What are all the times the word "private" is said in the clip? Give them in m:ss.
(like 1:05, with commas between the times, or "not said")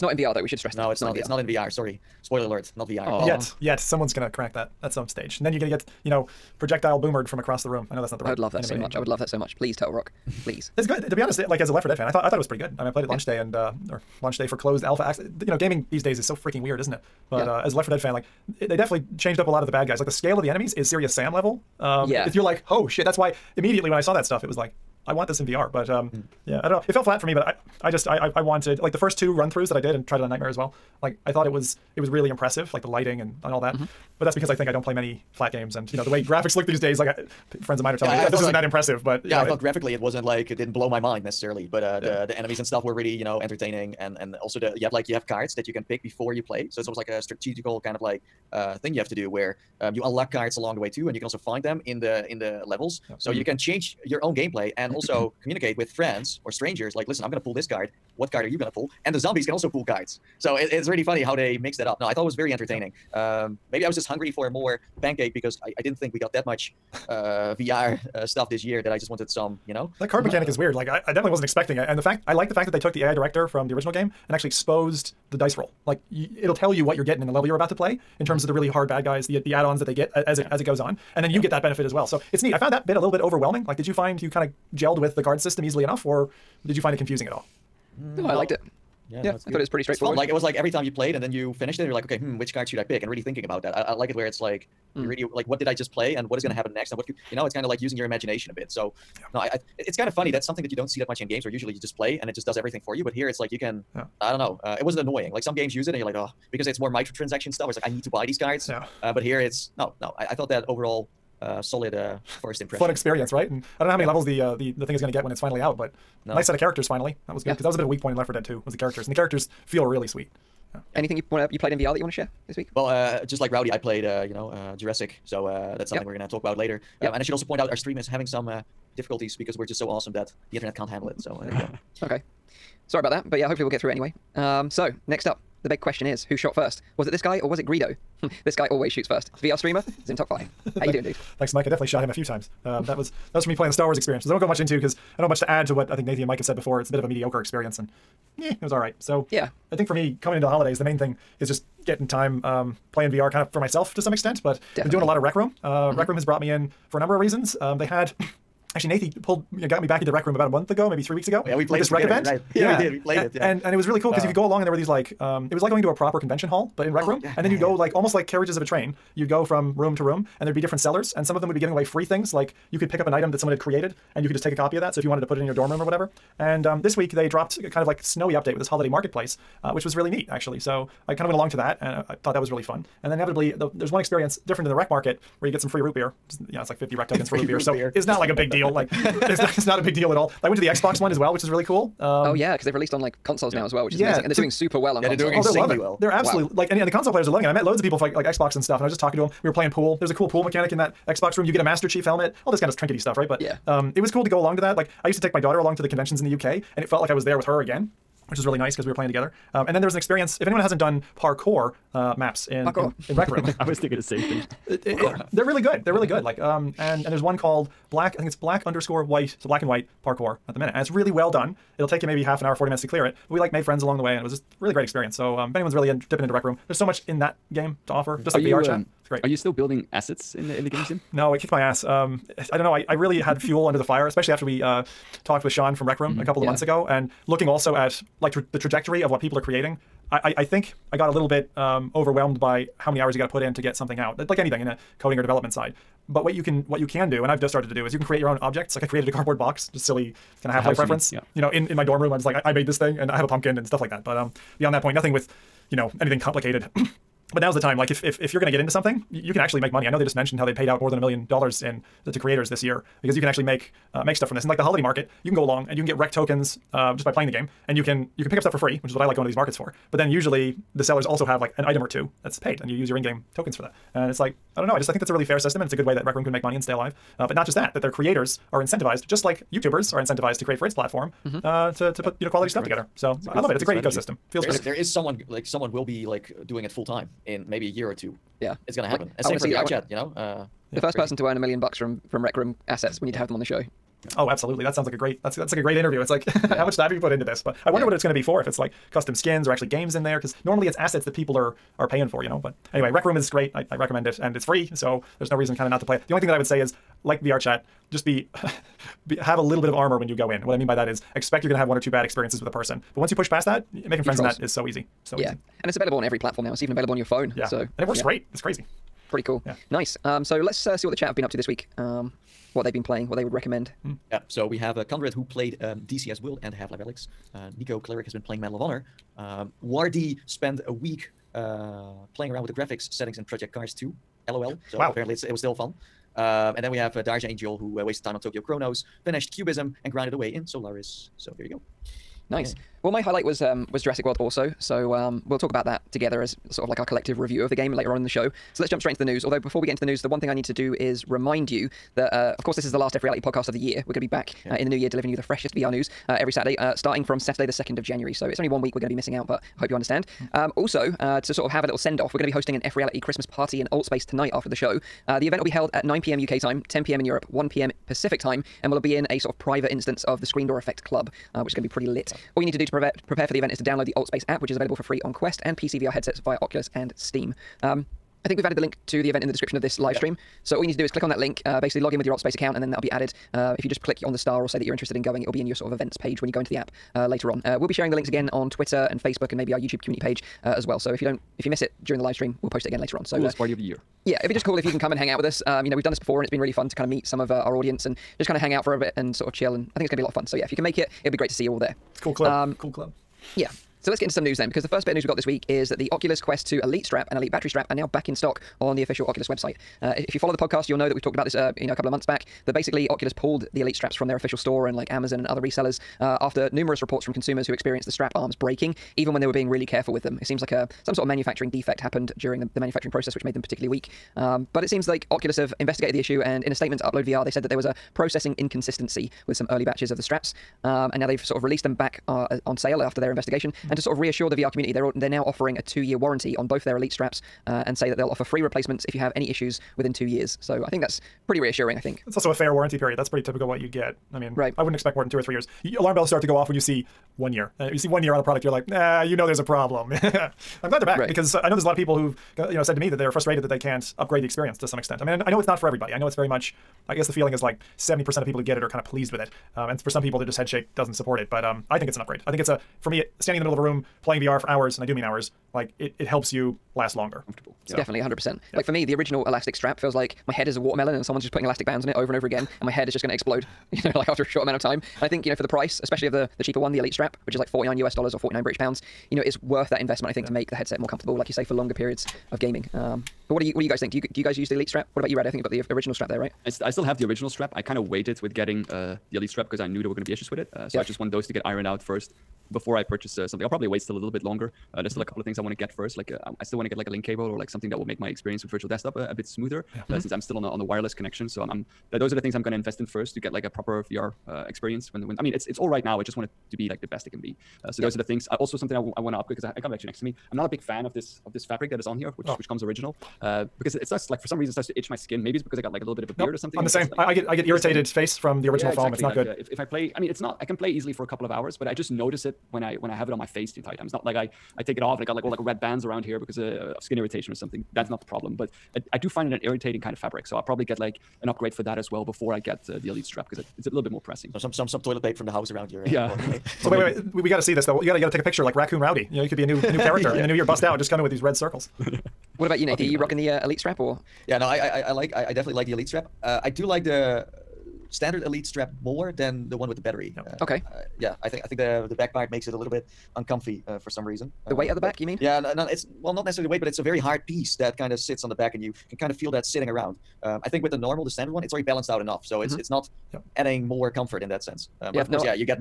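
6:09.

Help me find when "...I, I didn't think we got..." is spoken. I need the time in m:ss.
1:05.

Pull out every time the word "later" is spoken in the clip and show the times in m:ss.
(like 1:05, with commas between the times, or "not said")
2:06, 5:47, 6:27, 6:32.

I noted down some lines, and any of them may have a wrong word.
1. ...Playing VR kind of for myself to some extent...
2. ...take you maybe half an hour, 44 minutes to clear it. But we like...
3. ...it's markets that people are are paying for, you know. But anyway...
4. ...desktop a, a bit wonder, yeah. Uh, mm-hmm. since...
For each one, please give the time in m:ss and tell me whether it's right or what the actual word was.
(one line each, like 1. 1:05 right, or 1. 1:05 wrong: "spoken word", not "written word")
1. 2:32 right
2. 3:41 wrong: "40", not "44"
3. 5:00 wrong: "assets", not "markets"
4. 8:18 wrong: "smoother", not "wonder".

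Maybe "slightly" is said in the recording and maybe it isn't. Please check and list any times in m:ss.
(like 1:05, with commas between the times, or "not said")
not said.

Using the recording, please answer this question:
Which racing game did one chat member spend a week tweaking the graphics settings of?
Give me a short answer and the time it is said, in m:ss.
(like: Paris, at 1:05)
Project Cars 2, at 5:33.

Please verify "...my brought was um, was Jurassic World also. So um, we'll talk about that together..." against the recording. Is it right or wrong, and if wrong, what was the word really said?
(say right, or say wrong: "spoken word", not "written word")
wrong: "highlight", not "brought".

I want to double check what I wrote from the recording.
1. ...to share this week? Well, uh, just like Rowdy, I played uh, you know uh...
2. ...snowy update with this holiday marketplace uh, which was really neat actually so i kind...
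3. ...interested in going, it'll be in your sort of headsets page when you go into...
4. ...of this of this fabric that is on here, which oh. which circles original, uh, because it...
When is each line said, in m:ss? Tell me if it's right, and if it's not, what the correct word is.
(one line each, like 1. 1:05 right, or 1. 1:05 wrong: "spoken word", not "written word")
1. 2:02 right
2. 2:58 right
3. 6:24 wrong: "events", not "headsets"
4. 8:30 wrong: "comes", not "circles".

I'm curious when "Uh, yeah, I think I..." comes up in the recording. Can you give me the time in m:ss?
9:10.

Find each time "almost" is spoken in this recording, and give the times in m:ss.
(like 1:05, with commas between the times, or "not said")
0:46, 2:47.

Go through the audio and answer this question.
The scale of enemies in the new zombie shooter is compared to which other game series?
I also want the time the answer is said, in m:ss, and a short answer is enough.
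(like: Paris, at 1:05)
Serious Sam, at 0:20.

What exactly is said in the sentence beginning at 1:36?
happen next, and what could you know?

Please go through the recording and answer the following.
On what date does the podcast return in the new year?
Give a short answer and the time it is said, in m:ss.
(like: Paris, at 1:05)
2 January, at 5:57.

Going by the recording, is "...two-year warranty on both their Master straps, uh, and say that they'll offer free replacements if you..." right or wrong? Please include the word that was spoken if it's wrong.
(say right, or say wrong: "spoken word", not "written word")
wrong: "Elite", not "Master".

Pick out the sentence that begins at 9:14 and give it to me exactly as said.
The uh, weight at the back, but, you mean?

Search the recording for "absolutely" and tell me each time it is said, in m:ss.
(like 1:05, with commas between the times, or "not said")
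3:16, 4:54.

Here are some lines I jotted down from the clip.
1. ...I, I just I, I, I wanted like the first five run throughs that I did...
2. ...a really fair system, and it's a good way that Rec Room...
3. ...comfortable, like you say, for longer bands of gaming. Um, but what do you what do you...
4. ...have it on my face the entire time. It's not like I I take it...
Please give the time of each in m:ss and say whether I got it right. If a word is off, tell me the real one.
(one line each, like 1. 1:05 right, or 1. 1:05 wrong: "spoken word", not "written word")
1. 0:27 wrong: "two", not "five"
2. 4:35 right
3. 8:00 wrong: "periods", not "bands"
4. 8:42 right.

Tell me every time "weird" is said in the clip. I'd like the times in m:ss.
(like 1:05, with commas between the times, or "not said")
0:16, 1:10.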